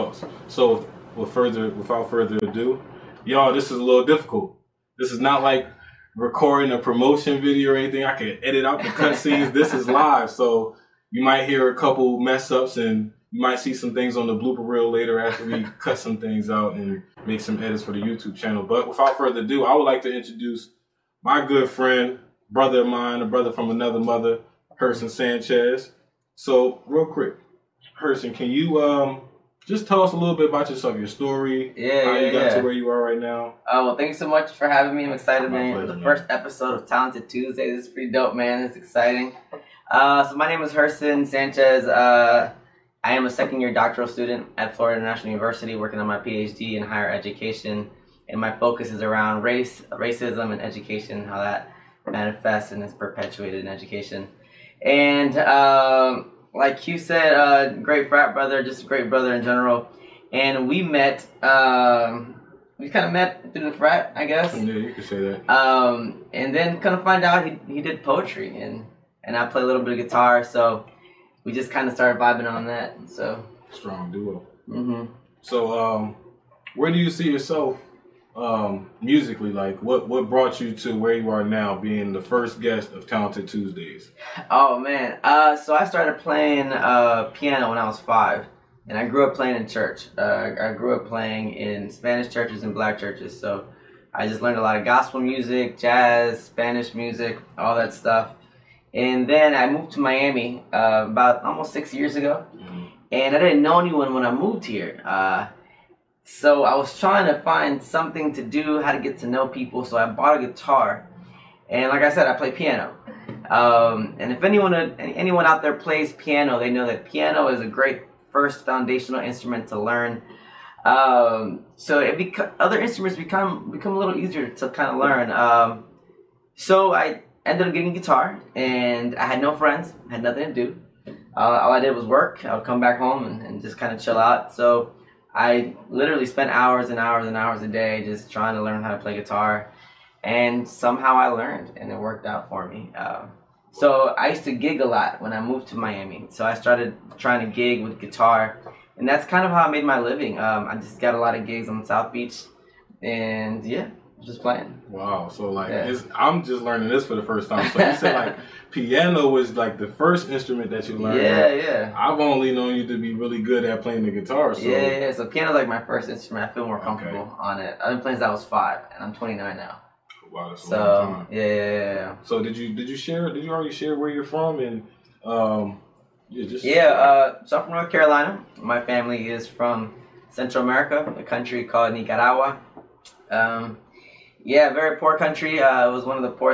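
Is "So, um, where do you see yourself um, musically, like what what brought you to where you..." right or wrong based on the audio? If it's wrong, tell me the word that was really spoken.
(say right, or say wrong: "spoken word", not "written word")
right.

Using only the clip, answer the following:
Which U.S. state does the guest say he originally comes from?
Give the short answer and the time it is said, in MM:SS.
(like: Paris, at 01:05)
North Carolina, at 02:57.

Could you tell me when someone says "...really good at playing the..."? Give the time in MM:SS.
02:43.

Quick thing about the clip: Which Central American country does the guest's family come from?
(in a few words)
Nicaragua.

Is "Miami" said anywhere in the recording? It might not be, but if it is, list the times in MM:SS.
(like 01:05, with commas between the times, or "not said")
01:39, 02:25.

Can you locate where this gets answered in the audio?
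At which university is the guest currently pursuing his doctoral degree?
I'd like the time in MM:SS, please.
00:44.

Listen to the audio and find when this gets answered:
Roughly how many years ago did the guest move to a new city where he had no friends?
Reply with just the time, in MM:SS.
01:41.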